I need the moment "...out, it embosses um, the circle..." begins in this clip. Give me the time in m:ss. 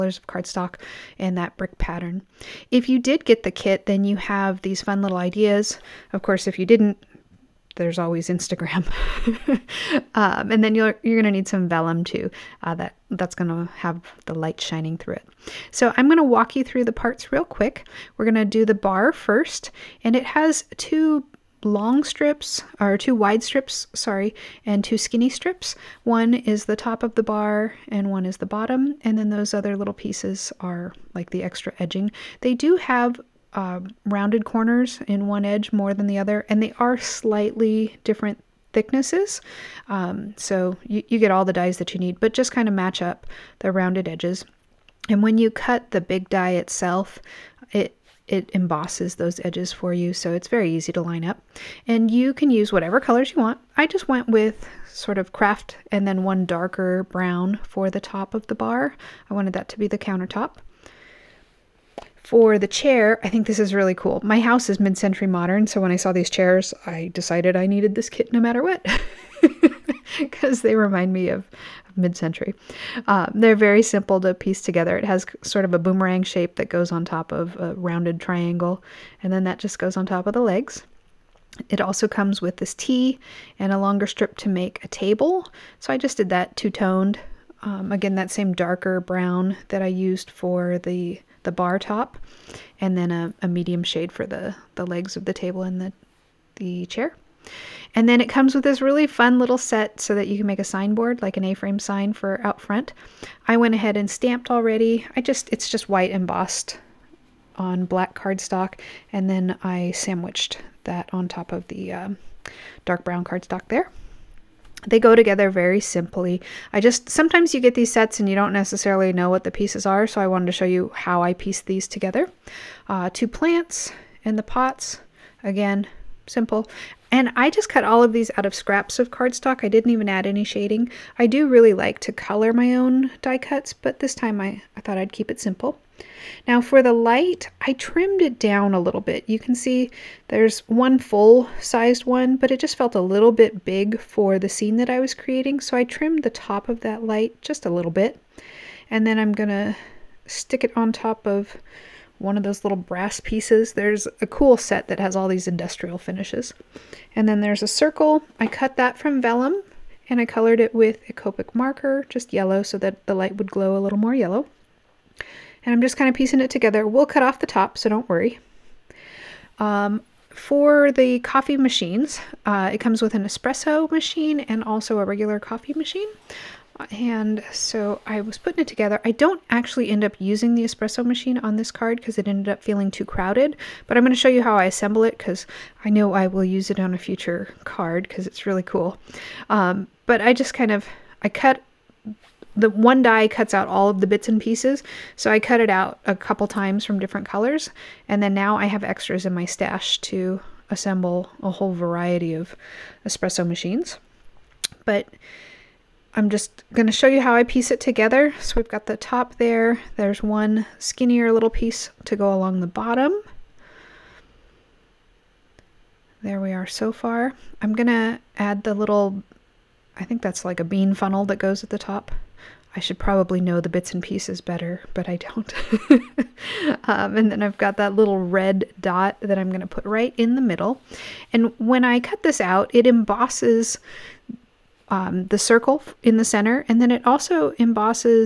3:52.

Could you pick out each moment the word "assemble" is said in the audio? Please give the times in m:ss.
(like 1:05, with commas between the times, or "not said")
3:04, 3:20.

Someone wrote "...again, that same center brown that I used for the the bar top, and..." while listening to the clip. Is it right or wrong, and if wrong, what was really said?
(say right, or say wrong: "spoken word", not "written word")
wrong: "darker", not "center".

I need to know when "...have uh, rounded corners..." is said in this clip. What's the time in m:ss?
0:32.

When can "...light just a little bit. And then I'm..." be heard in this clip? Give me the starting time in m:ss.
2:27.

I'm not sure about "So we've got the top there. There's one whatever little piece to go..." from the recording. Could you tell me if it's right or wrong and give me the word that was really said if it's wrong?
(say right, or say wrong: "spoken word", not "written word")
wrong: "skinnier", not "whatever".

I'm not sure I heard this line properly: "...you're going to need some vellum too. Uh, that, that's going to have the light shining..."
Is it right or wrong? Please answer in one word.
right.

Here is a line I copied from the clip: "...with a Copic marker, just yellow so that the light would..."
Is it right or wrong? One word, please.
right.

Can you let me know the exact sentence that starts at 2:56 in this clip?
And so I was putting it together.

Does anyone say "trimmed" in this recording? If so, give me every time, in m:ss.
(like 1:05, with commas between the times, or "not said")
2:17, 2:25.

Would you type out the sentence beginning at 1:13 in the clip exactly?
Uh, um, they're very simple to piece together.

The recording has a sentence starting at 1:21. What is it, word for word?
It also comes with this T and a longer strip to make a table.